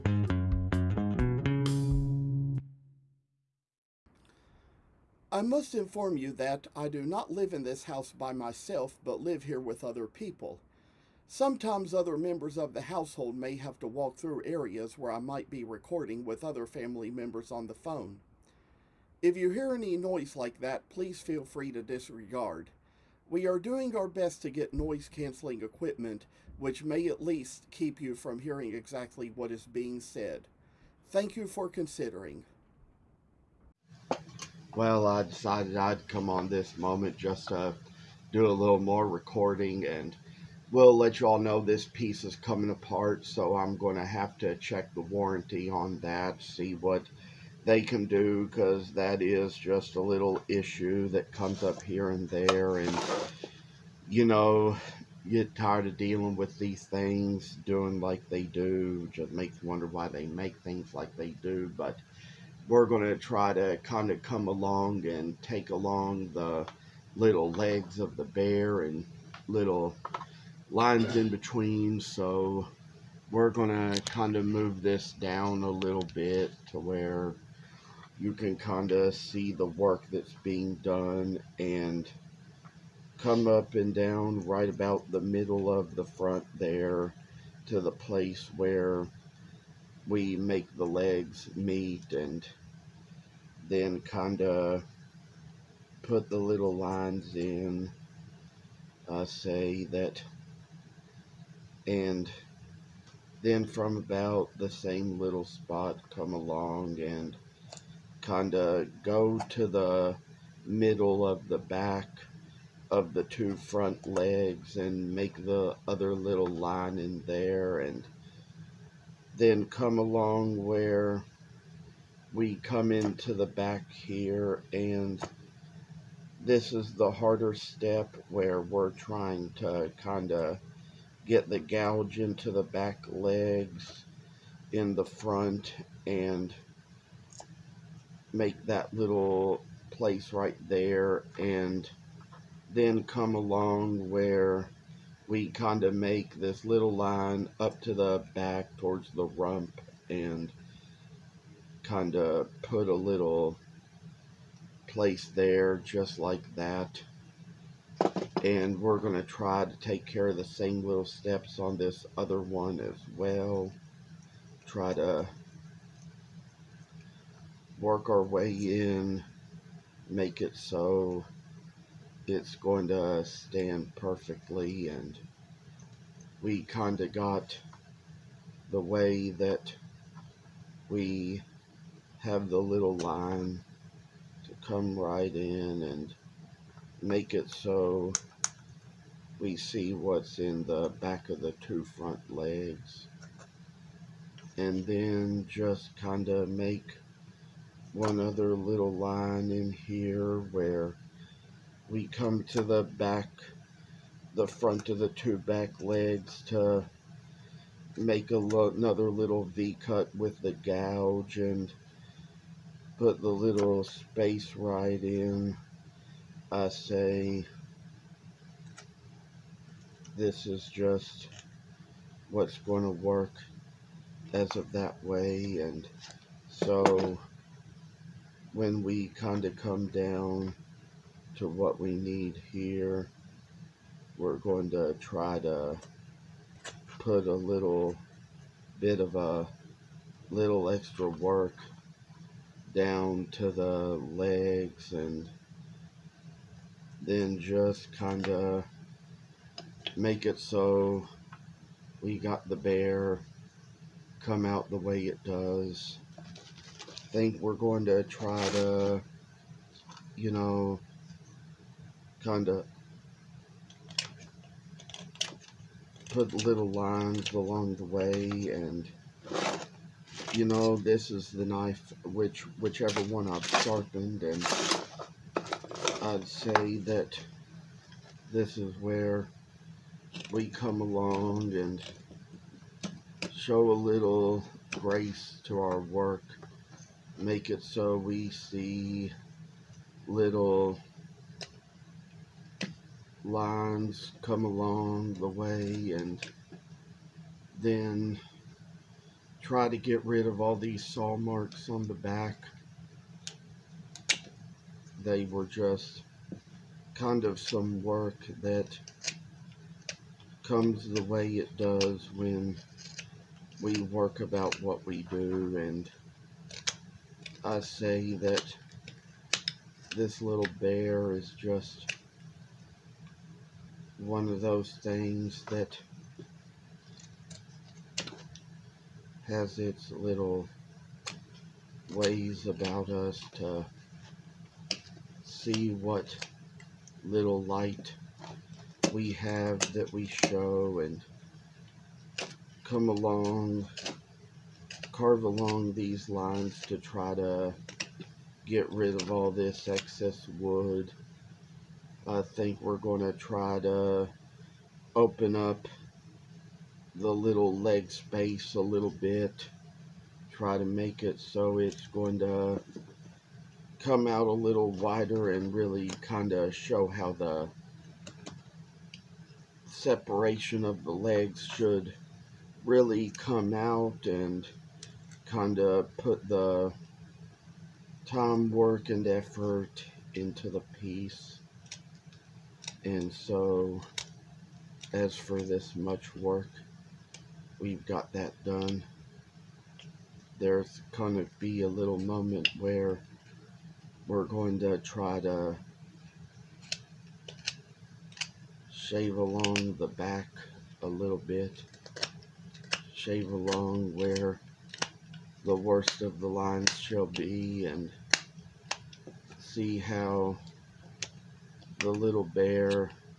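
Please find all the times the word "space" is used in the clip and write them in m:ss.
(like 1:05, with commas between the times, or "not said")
3:33, 5:57.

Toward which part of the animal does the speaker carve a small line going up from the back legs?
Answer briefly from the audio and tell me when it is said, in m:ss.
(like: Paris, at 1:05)
the rump, at 2:29.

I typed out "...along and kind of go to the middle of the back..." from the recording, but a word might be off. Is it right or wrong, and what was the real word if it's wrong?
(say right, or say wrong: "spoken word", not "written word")
right.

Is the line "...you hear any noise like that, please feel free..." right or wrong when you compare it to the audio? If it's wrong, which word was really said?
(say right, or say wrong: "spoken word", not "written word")
right.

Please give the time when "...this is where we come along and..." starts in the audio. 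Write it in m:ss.
4:38.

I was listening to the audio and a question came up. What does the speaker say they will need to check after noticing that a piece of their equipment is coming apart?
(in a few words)
the warranty.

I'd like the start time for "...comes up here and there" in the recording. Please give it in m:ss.
0:51.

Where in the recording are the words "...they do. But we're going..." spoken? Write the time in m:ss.
1:01.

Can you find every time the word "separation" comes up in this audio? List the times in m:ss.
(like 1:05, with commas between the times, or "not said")
6:09.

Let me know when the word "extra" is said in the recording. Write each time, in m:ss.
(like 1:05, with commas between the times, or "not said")
4:00.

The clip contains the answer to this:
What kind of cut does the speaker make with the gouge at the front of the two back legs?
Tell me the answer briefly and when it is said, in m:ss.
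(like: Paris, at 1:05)
V-cut, at 3:29.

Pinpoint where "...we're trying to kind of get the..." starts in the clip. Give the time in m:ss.
2:08.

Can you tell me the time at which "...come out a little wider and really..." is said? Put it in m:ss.
6:03.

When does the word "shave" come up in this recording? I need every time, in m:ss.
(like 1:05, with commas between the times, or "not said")
6:38, 6:42.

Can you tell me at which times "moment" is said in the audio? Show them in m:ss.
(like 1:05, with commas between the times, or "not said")
0:36, 6:31.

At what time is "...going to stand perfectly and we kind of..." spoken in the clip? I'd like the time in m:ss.
2:52.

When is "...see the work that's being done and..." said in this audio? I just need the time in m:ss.
1:19.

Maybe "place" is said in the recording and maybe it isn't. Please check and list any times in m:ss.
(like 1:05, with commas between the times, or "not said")
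1:27, 2:19, 2:34.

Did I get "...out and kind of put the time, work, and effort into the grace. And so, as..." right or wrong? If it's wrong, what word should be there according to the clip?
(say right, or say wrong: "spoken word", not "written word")
wrong: "piece", not "grace".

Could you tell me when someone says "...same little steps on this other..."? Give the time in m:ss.
2:40.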